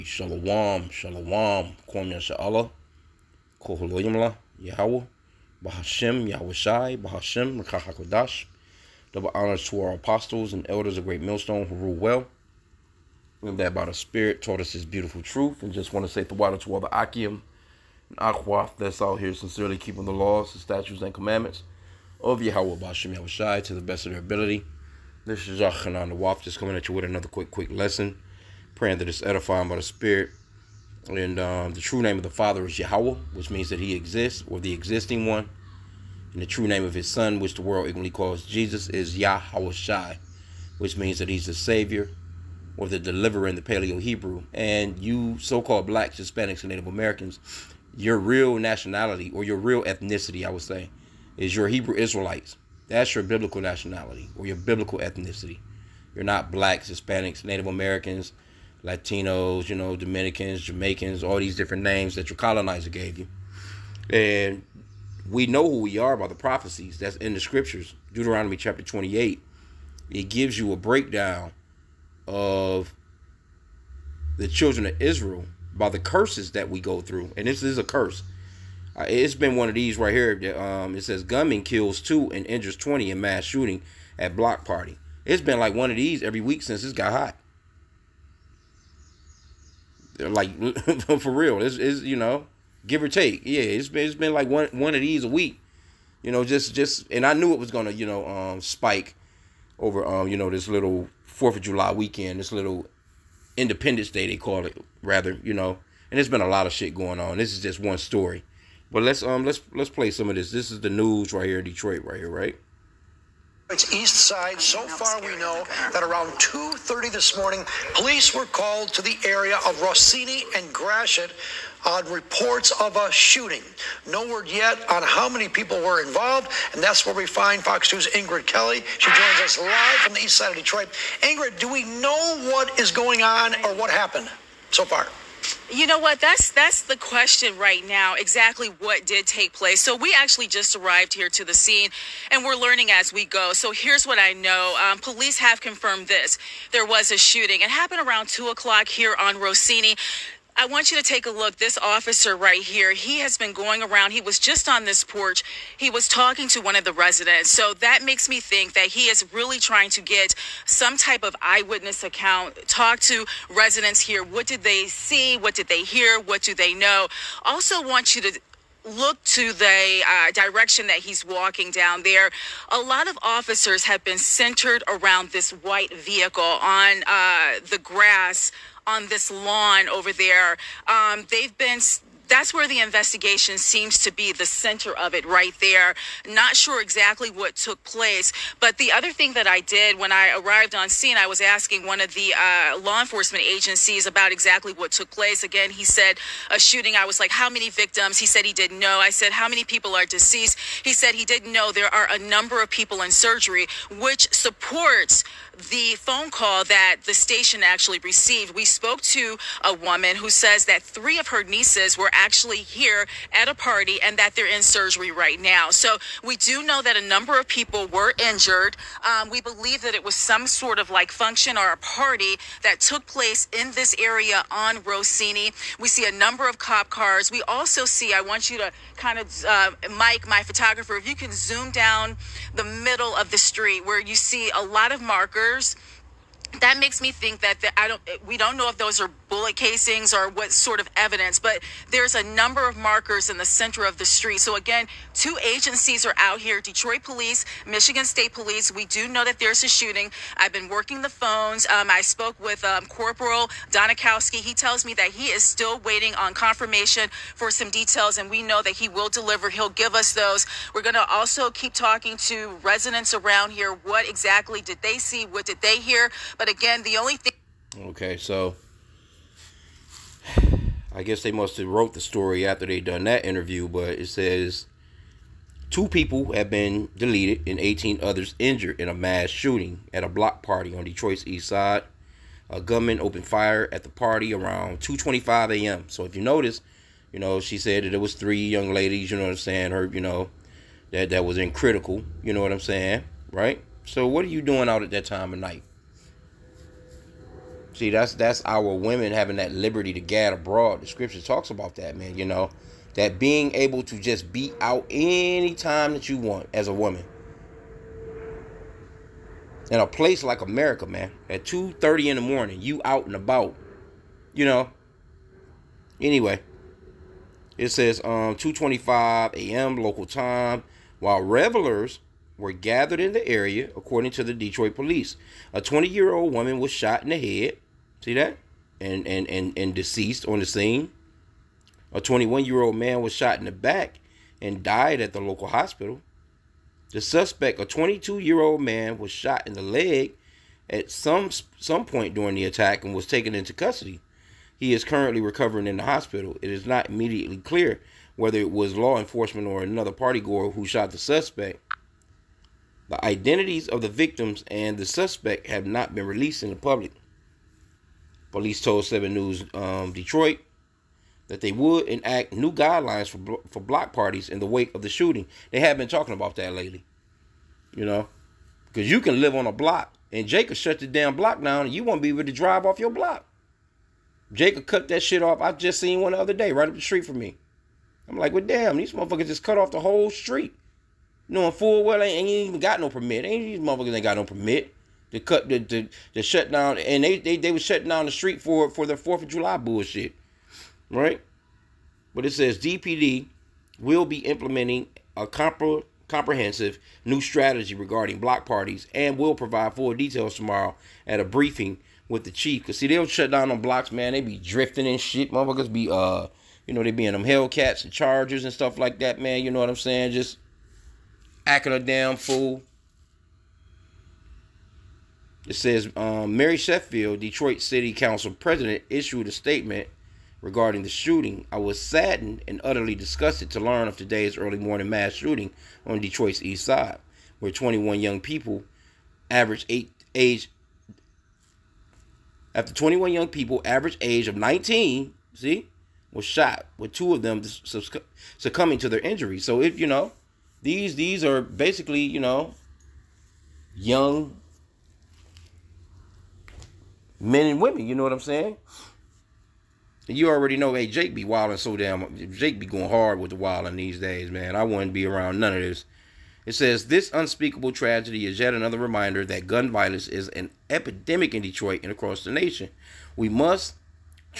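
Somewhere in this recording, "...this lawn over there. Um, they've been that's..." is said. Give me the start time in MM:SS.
02:59.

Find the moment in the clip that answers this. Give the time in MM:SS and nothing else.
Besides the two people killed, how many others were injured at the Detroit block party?
04:37.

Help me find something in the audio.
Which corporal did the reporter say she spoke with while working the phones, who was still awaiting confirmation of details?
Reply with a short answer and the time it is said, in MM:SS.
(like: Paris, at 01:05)
Corporal Donikowski, at 04:12.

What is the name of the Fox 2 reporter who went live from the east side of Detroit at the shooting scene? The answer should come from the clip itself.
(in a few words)
Ingrid Kelly.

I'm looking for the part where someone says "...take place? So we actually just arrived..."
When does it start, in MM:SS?
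02:19.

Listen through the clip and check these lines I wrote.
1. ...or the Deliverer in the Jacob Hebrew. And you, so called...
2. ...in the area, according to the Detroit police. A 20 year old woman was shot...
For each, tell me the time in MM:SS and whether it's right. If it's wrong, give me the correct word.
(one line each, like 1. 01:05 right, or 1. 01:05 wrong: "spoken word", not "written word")
1. 00:42 wrong: "Paleo", not "Jacob"
2. 05:22 right.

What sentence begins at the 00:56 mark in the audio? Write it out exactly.
You're not blacks, Hispanics, Native Americans Latinos, you know, Dominicans, Jamaicans, all these different names that your colonizer gave you.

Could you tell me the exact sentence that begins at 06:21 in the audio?
Knowing full well they ain't even got no permit.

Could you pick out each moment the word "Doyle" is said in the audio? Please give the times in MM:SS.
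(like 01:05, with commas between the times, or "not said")
not said.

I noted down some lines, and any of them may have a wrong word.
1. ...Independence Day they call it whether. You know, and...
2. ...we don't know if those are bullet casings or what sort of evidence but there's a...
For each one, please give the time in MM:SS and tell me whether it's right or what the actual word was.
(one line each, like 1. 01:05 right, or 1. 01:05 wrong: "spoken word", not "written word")
1. 01:43 wrong: "rather", not "whether"
2. 03:58 right.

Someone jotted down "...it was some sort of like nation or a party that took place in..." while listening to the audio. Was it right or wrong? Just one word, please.
wrong.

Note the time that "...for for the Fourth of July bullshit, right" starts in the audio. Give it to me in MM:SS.
06:28.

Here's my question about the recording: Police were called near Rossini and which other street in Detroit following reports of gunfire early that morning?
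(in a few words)
Gratiot.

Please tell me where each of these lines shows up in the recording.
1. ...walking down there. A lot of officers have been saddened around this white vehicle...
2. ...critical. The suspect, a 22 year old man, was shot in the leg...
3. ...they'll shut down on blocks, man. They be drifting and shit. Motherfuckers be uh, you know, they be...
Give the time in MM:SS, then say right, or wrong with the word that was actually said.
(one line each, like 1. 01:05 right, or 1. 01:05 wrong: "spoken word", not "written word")
1. 02:51 wrong: "centered", not "saddened"
2. 05:35 wrong: "hospital", not "critical"
3. 06:42 right.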